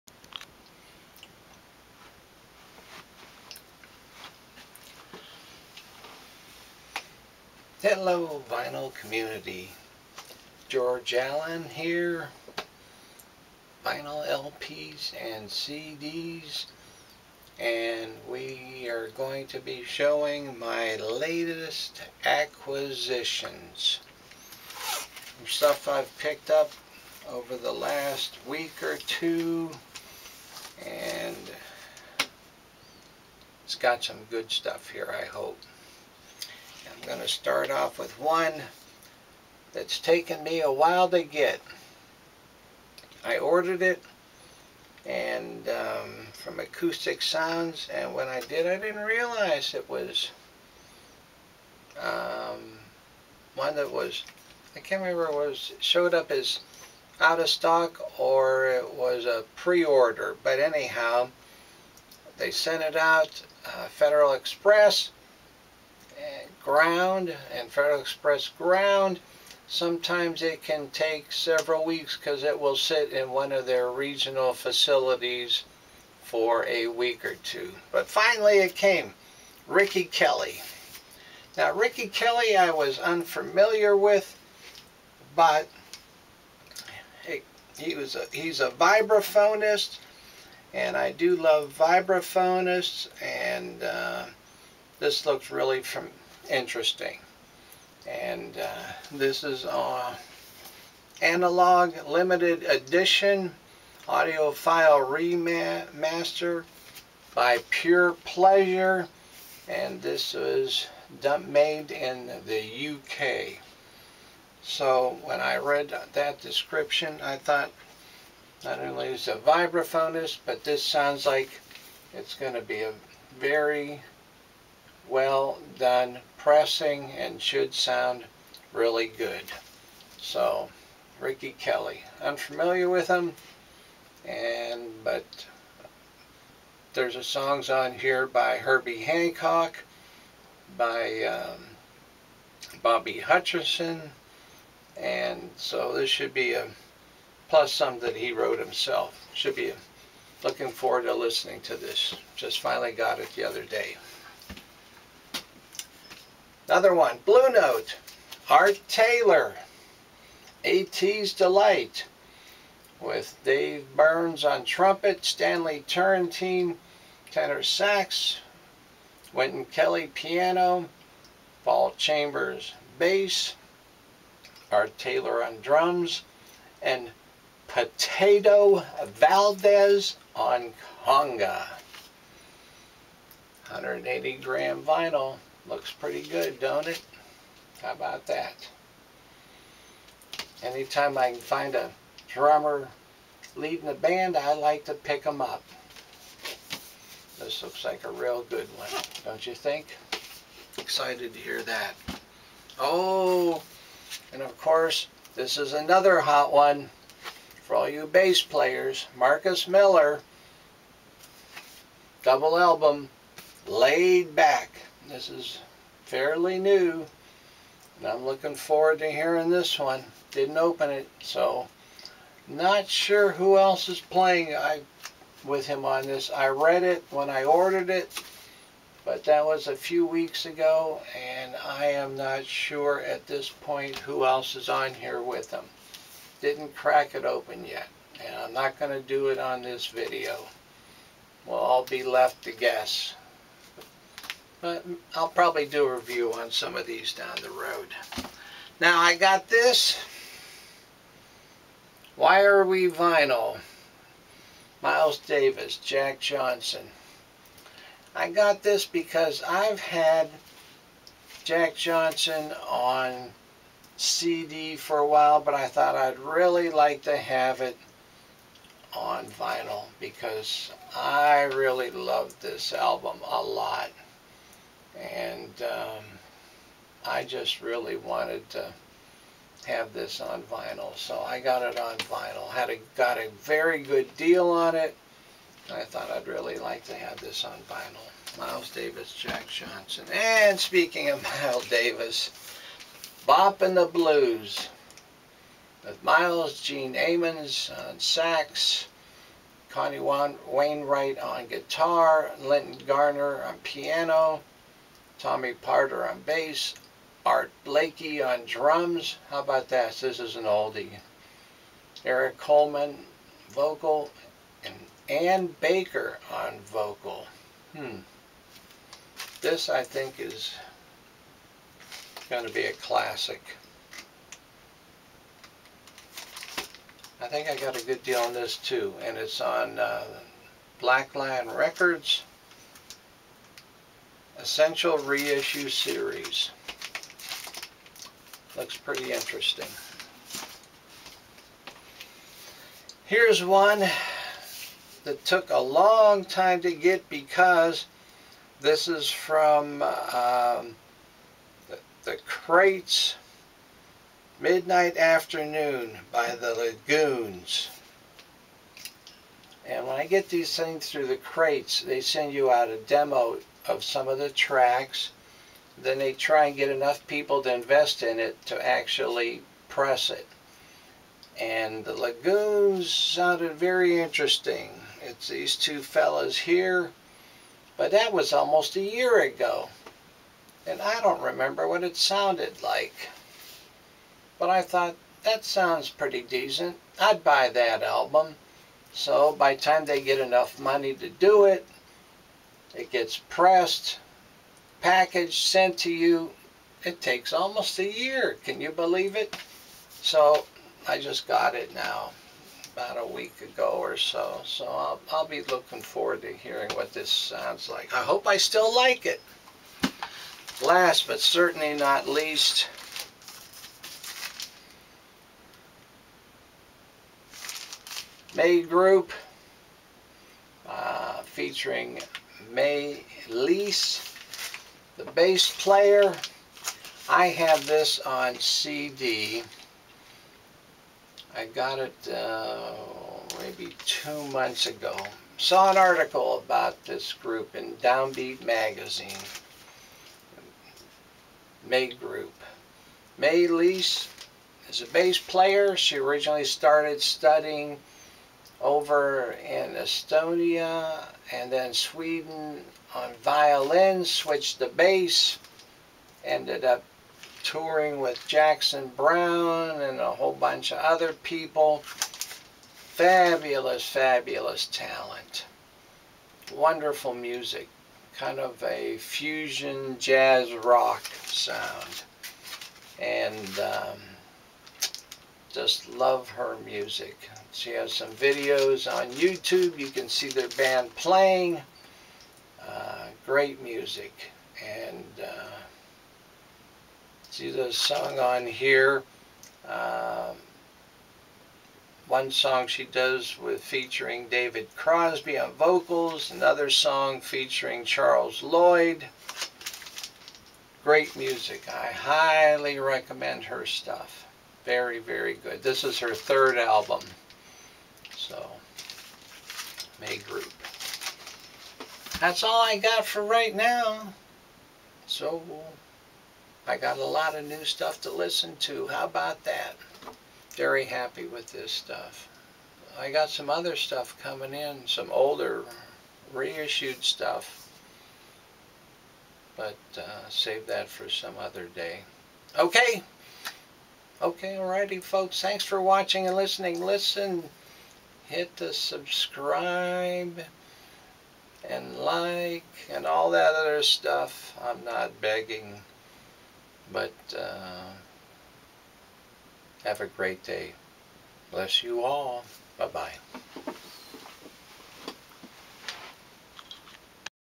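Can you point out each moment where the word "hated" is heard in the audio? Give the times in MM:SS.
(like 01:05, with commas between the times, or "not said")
not said.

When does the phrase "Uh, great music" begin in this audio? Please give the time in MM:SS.
08:02.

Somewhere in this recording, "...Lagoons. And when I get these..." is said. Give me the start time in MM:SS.
05:56.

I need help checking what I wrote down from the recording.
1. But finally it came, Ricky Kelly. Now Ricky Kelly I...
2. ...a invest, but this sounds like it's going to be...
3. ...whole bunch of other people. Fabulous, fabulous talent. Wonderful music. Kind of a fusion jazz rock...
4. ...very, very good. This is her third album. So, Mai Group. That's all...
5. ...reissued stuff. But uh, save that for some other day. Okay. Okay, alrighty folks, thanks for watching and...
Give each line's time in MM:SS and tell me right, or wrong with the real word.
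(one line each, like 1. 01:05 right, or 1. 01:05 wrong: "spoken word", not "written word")
1. 01:17 right
2. 01:59 wrong: "vibraphonist", not "invest"
3. 07:40 right
4. 08:24 right
5. 08:46 right.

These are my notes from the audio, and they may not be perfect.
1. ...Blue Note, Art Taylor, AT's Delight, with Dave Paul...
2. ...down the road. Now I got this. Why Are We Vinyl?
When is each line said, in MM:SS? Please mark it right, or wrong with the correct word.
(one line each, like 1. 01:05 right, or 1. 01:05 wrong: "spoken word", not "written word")
1. 02:37 wrong: "Burns", not "Paul"
2. 04:07 right.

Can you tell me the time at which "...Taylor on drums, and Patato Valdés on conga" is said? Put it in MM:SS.
02:54.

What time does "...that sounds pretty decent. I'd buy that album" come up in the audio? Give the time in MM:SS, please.
06:25.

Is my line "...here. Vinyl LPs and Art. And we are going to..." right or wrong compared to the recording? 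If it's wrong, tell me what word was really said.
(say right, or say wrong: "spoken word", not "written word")
wrong: "CDs", not "Art".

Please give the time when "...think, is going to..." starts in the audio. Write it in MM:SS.
05:19.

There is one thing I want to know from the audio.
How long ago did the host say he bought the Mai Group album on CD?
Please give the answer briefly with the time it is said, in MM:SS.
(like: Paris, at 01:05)
2 months ago, at 07:13.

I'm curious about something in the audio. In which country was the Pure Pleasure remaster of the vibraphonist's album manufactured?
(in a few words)
UK.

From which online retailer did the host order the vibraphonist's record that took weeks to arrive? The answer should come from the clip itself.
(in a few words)
Acoustic Sounds.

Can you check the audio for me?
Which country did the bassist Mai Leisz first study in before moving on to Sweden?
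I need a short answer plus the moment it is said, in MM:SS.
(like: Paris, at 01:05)
Estonia, at 07:29.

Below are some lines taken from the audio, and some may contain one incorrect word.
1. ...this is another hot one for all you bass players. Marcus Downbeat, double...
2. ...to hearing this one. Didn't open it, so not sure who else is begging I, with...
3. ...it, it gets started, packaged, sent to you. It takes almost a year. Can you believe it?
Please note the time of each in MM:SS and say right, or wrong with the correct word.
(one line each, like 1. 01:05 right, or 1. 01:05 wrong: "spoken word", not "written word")
1. 03:25 wrong: "Miller", not "Downbeat"
2. 03:38 wrong: "playing", not "begging"
3. 06:31 wrong: "pressed", not "started".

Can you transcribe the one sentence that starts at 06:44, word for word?
So I'll, I'll be looking forward to hearing what this sounds like.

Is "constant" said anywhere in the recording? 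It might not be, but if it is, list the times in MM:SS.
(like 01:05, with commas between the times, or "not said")
not said.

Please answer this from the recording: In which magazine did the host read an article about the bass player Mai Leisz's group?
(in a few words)
Downbeat.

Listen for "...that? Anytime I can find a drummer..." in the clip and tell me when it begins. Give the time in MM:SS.
03:08.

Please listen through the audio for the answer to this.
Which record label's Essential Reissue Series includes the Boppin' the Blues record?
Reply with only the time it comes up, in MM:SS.
05:30.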